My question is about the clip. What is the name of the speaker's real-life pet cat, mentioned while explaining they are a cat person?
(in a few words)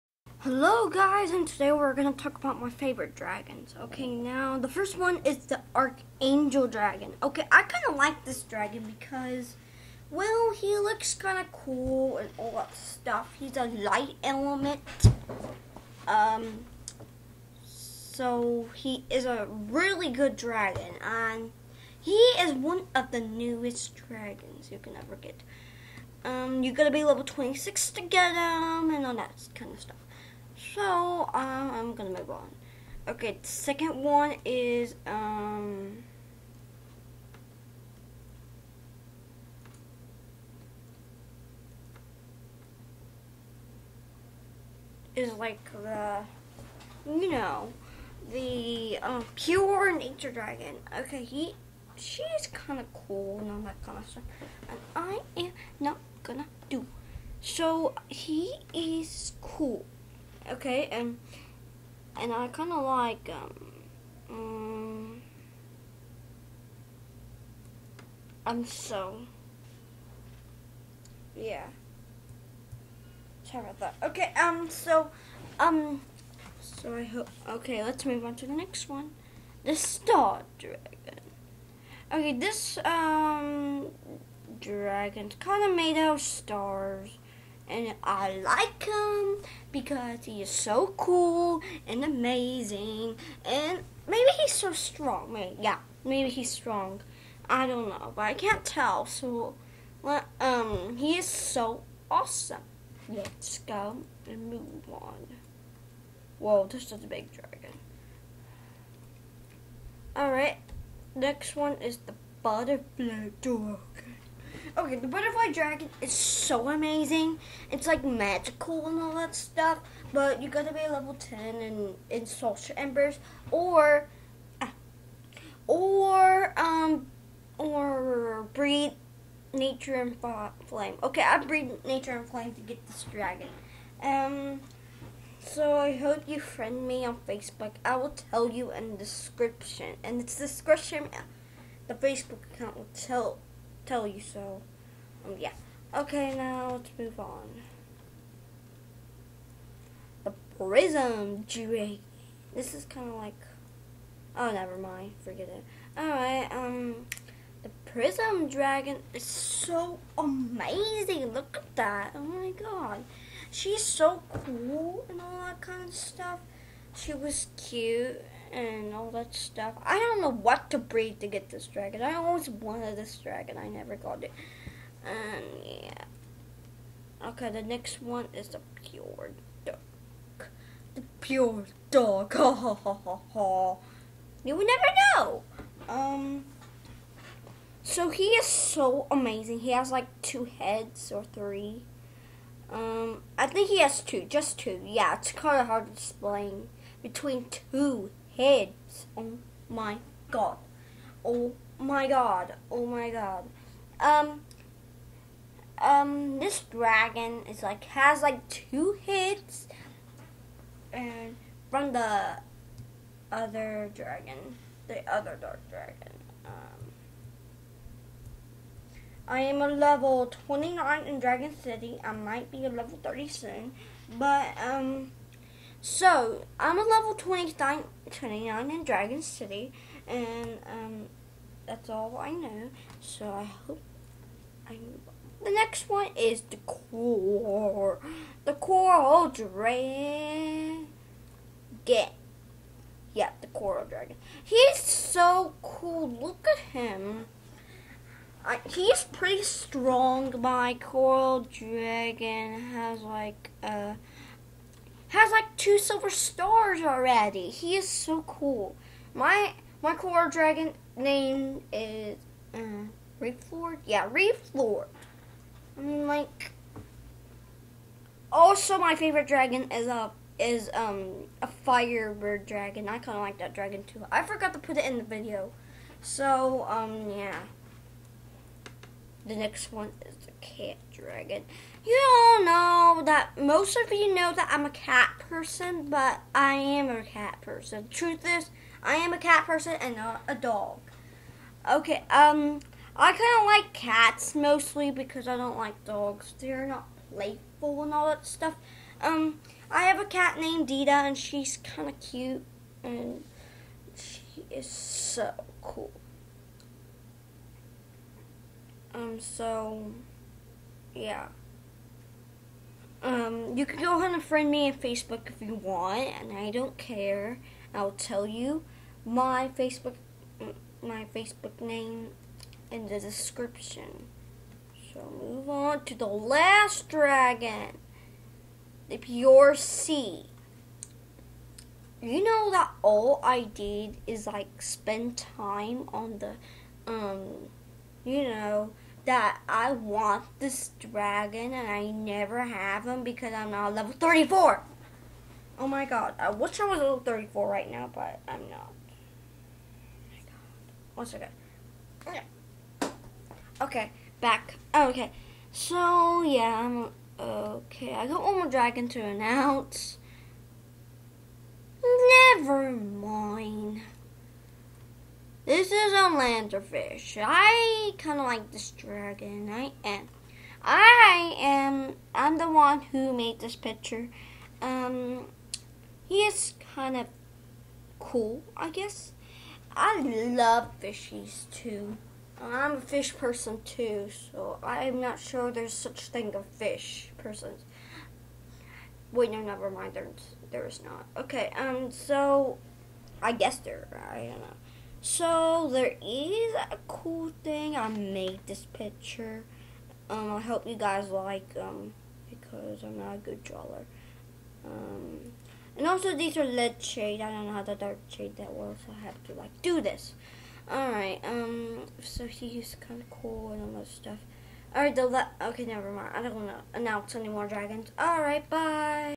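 Dita.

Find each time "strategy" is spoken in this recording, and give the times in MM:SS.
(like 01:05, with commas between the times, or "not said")
not said.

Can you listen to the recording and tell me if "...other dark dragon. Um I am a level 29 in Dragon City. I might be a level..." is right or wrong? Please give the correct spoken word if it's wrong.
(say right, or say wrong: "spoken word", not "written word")
right.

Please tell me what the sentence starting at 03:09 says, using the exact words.
He has like two heads or three.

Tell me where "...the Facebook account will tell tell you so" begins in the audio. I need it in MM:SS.
02:21.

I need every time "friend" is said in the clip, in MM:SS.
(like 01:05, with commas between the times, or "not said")
02:16, 05:14.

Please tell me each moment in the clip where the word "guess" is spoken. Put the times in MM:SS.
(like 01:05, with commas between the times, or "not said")
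06:18, 06:33.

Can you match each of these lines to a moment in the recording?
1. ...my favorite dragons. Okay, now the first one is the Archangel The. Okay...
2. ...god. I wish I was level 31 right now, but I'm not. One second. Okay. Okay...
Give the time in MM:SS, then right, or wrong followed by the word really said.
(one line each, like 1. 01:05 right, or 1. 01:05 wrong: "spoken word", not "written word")
1. 00:02 wrong: "Dragon", not "The"
2. 05:45 wrong: "34", not "31".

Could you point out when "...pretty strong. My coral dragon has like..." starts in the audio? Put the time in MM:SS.
04:09.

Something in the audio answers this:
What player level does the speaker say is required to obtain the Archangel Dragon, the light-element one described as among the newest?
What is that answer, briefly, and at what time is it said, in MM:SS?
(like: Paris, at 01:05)
26, at 00:27.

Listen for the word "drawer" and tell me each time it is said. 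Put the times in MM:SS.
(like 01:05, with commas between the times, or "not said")
06:43.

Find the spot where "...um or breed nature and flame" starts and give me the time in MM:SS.
02:06.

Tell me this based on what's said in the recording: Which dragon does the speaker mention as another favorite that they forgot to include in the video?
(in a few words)
Firebird dragon.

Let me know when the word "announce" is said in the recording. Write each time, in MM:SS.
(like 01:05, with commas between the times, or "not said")
05:58, 06:56.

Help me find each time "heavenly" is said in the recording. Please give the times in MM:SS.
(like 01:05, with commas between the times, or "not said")
not said.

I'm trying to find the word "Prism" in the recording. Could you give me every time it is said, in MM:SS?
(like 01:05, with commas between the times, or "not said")
02:30, 02:37.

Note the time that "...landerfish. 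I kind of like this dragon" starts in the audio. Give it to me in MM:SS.
06:06.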